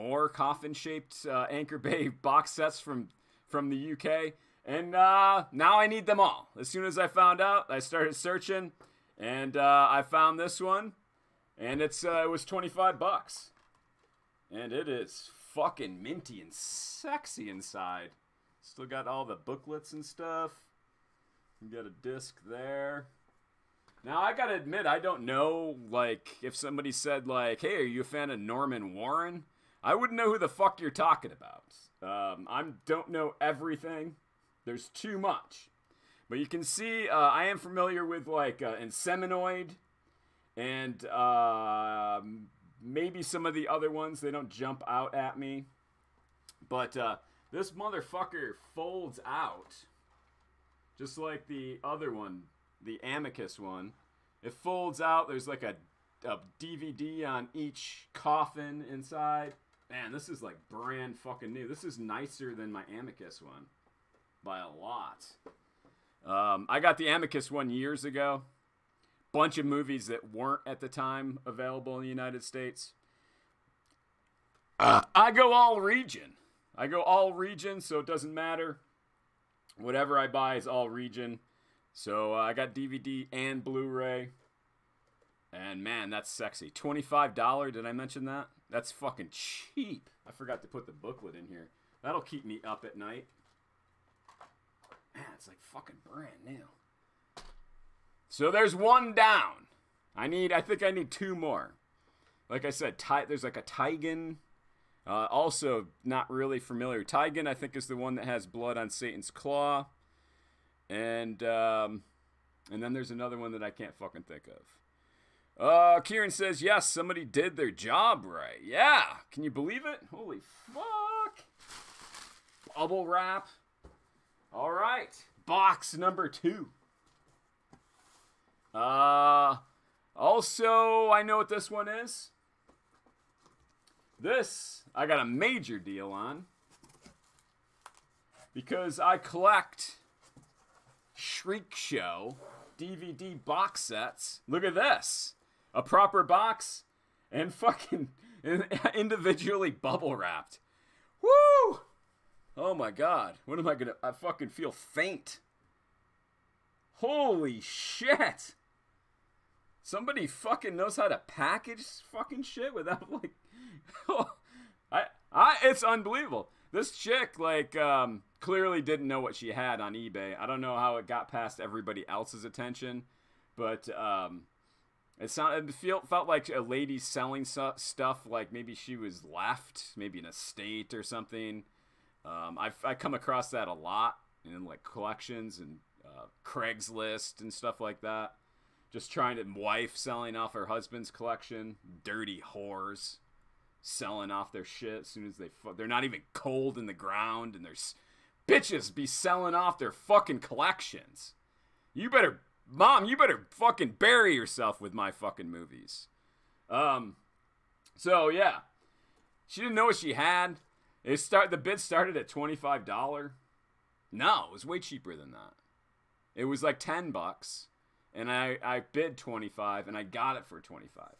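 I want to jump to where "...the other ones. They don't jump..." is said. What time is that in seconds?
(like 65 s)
43 s.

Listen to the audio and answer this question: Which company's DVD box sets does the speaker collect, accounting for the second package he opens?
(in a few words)
Shriek Show.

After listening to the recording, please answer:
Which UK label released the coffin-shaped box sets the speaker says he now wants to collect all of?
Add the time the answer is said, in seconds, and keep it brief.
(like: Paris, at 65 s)
Anchor Bay, at 1 s.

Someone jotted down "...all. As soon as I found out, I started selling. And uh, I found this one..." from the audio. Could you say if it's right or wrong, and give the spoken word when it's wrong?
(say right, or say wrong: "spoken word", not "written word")
wrong: "searching", not "selling".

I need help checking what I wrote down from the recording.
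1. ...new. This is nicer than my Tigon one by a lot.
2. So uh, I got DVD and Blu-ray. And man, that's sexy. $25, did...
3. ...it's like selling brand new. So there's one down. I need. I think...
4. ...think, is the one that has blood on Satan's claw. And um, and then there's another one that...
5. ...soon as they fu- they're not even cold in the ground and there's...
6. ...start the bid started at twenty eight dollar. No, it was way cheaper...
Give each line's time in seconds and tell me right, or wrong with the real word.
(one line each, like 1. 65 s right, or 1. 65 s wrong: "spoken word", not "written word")
1. 61 s wrong: "Amicus", not "Tigon"
2. 81 s right
3. 95 s wrong: "fucking", not "selling"
4. 107 s right
5. 195 s right
6. 211 s wrong: "five", not "eight".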